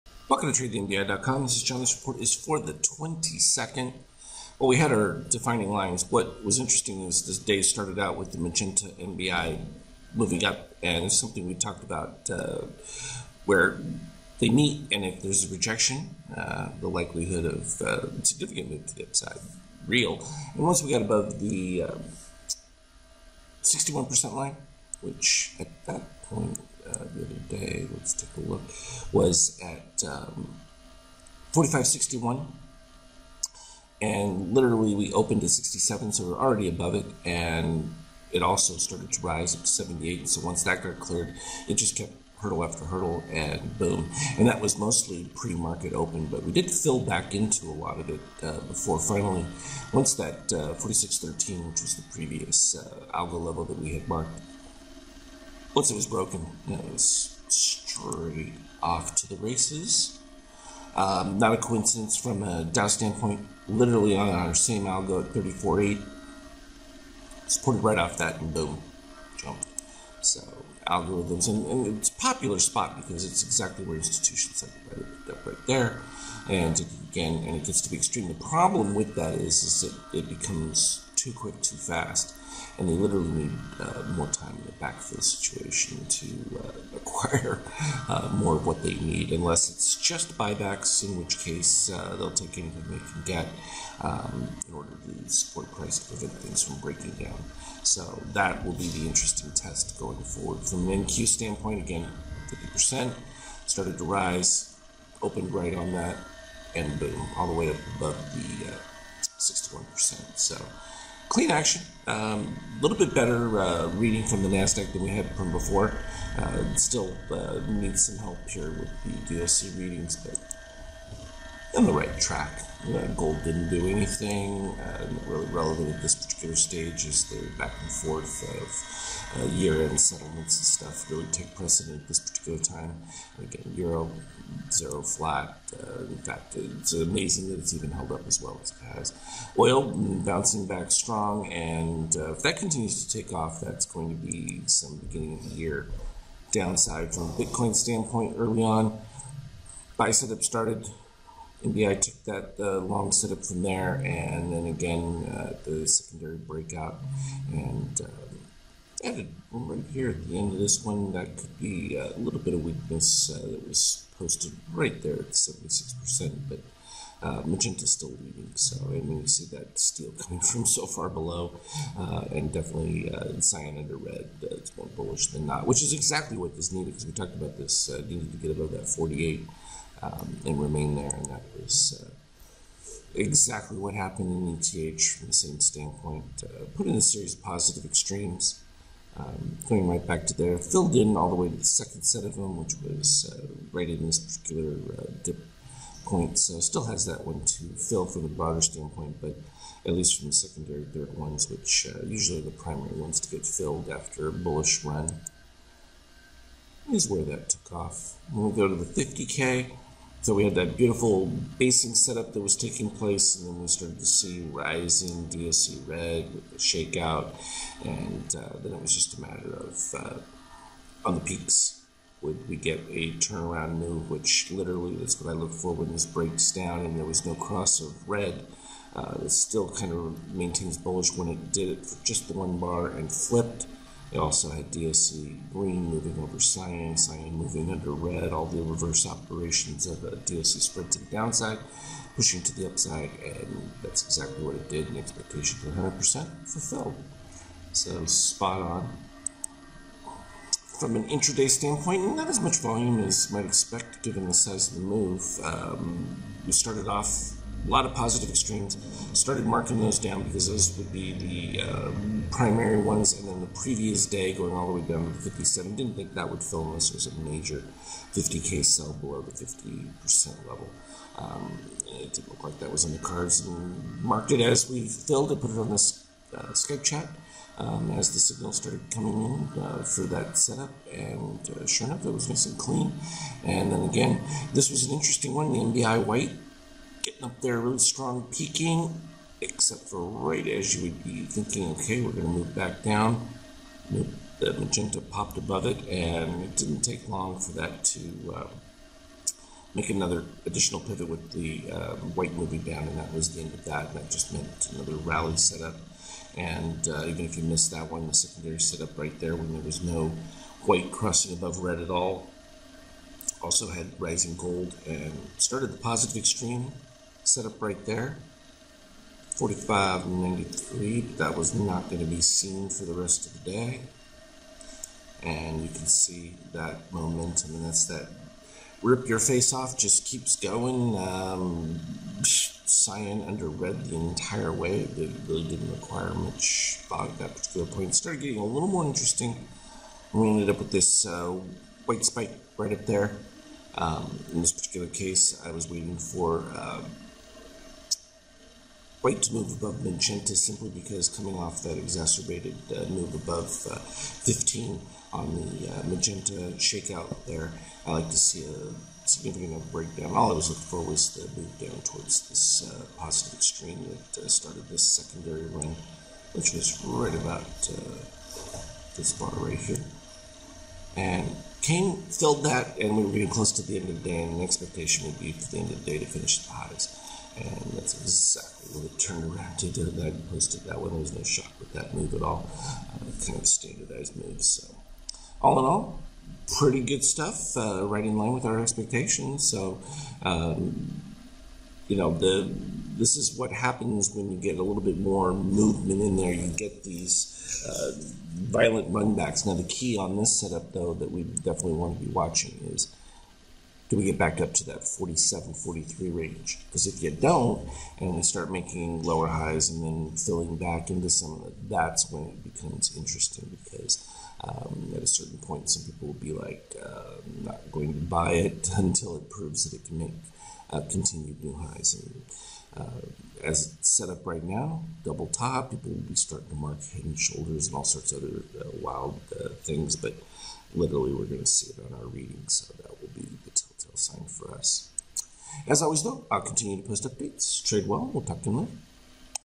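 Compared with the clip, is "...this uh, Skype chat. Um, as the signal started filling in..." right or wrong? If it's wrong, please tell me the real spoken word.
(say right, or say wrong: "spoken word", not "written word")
wrong: "coming", not "filling".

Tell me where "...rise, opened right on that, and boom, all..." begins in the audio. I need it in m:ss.
1:44.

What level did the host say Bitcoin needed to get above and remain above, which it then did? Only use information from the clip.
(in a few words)
48.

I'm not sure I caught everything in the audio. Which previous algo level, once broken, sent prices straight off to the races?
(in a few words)
46.13.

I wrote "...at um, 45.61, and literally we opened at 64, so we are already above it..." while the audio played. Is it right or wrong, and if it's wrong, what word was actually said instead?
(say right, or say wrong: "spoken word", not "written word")
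wrong: "67", not "64".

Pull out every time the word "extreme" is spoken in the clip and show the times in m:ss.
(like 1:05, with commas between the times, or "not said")
1:17, 3:07, 4:18, 5:16, 6:03.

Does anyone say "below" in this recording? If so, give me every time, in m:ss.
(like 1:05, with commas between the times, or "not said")
2:51, 4:28.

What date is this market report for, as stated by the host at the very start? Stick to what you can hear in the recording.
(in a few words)
22nd.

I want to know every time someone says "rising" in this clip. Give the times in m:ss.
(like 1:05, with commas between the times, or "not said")
3:34, 5:13.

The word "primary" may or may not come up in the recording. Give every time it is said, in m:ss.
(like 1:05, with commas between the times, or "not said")
3:22, 4:22.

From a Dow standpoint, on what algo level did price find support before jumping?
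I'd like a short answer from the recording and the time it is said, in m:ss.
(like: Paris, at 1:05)
34.8, at 1:05.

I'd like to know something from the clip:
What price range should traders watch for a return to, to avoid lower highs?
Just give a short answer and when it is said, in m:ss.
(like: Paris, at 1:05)
47, 43, at 6:44.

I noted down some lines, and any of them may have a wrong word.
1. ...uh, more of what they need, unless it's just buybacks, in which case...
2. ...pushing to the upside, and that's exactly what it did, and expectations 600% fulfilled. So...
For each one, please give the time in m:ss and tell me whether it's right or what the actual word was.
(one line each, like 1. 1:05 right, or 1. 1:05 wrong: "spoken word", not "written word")
1. 1:28 right
2. 4:02 wrong: "100", not "600".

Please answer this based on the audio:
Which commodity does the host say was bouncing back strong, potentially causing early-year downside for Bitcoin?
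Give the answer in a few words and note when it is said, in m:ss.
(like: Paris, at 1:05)
Oil, at 2:19.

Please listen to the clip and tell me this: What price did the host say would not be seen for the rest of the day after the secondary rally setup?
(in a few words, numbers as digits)
4593.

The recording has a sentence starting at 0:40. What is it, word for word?
And so once that got cleared, it just kept hurdle after hurdle, and boom.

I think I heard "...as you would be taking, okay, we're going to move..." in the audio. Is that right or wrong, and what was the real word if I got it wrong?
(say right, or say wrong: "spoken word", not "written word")
wrong: "thinking", not "taking".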